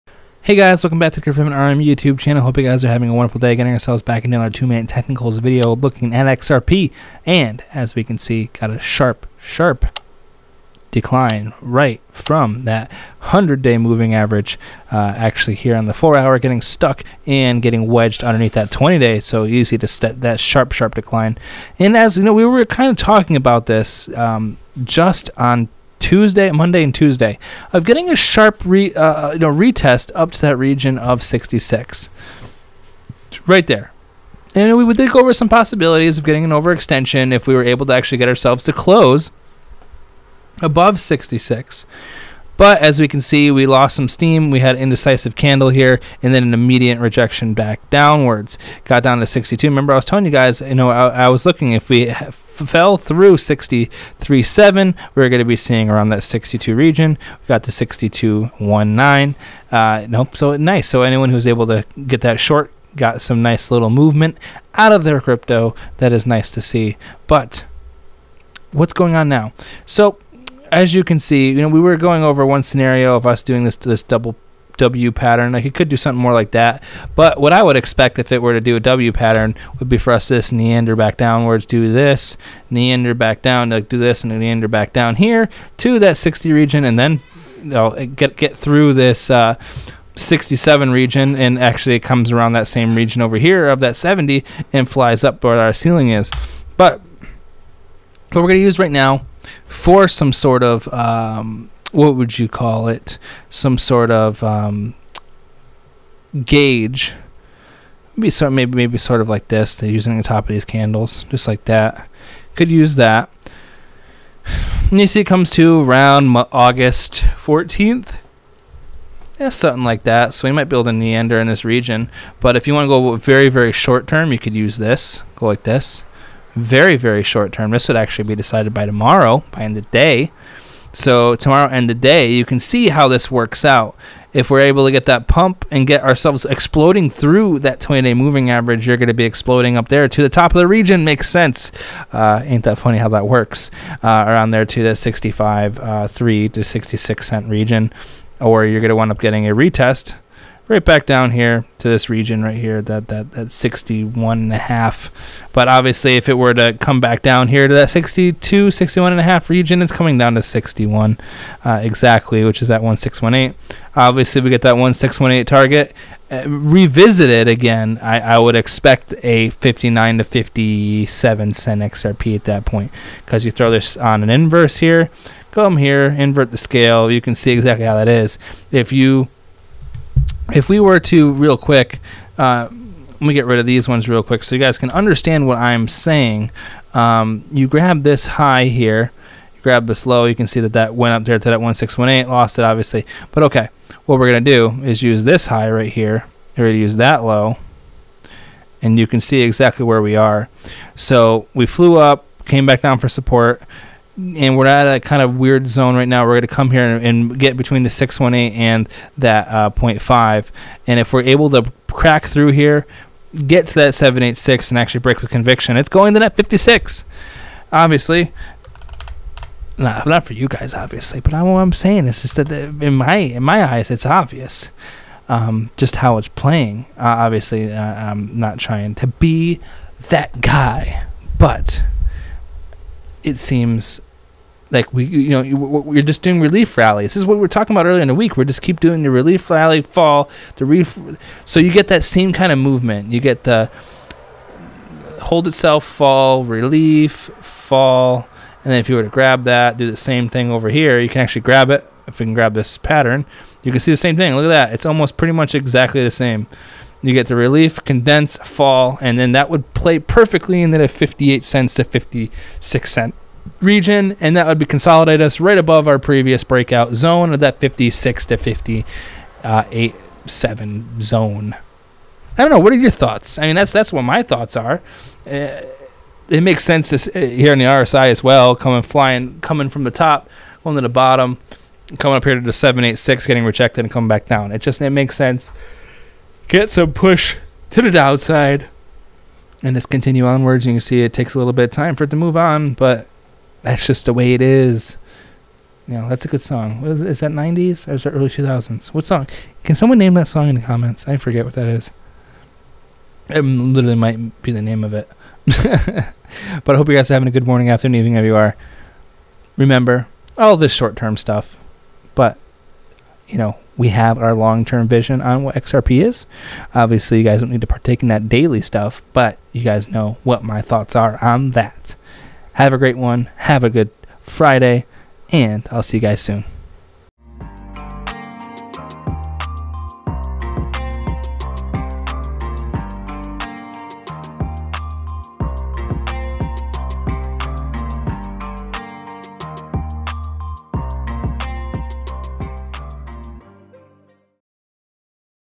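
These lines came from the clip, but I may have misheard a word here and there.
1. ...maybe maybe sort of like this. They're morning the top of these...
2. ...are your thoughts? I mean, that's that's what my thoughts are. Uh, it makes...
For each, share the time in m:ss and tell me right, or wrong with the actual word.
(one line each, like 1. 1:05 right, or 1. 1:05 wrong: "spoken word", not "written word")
1. 1:48 wrong: "using", not "morning"
2. 4:32 right.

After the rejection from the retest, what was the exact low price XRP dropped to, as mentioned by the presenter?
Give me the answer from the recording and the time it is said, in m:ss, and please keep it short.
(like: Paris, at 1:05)
62.19, at 0:57.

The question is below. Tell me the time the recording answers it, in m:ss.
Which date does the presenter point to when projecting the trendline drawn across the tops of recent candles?
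1:56.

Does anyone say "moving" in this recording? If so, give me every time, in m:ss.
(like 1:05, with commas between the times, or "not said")
0:13, 2:18.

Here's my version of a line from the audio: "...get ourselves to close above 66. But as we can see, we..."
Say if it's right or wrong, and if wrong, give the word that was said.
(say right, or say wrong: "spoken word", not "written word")
right.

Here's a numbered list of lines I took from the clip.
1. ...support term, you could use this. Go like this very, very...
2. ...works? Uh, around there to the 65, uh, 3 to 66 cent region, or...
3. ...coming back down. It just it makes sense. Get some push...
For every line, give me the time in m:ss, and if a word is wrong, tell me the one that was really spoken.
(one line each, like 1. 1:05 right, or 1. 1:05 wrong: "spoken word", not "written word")
1. 2:03 wrong: "short", not "support"
2. 2:23 right
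3. 4:43 right.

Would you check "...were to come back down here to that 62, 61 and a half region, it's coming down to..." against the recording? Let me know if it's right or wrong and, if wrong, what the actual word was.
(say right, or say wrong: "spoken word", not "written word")
right.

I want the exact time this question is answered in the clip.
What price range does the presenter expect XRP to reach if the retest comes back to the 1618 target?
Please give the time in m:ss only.
2:49.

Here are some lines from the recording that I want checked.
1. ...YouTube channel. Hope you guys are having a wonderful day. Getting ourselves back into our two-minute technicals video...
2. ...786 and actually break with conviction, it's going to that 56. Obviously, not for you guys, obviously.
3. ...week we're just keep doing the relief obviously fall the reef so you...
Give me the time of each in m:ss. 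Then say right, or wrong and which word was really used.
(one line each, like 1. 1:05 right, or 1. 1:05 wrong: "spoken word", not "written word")
1. 0:01 right
2. 3:33 right
3. 3:58 wrong: "rally", not "obviously".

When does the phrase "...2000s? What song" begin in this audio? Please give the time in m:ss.
4:58.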